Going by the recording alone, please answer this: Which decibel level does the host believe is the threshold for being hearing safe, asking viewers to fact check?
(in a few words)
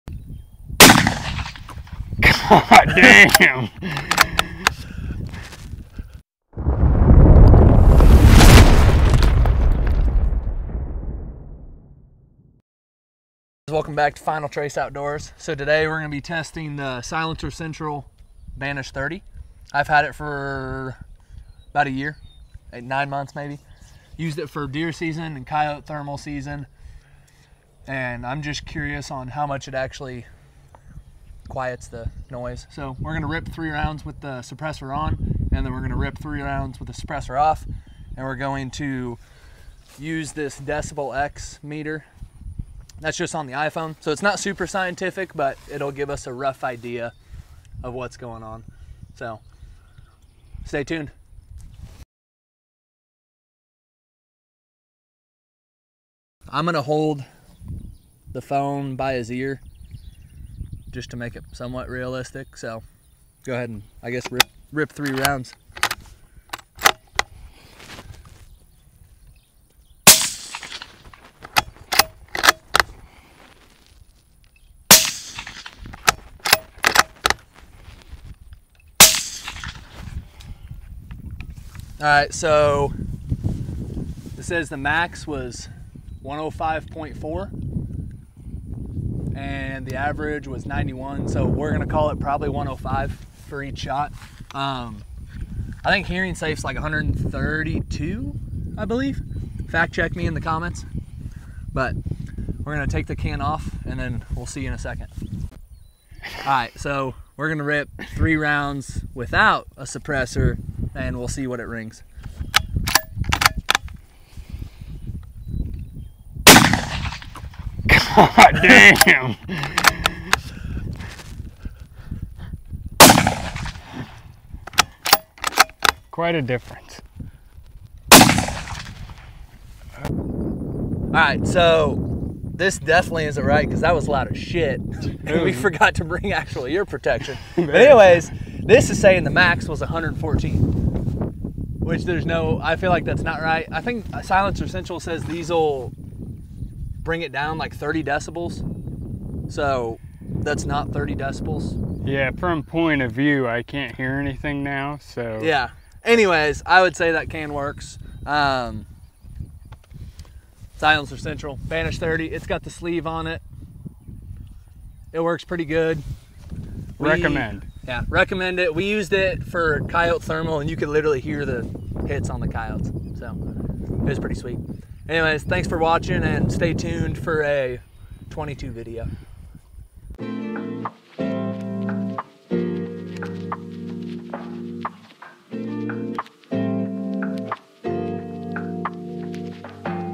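132.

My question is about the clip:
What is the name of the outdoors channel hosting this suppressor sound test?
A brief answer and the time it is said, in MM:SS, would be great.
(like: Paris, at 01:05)
Final Trace Outdoors, at 00:14.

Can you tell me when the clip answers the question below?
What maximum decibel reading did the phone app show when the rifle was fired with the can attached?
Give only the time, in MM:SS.
01:26.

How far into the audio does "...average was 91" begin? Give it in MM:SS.
01:29.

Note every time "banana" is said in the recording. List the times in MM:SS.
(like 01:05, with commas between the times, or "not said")
not said.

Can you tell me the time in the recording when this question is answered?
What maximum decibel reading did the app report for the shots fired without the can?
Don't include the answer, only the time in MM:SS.
02:19.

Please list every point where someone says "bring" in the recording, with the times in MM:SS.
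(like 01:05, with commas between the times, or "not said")
02:16, 02:27.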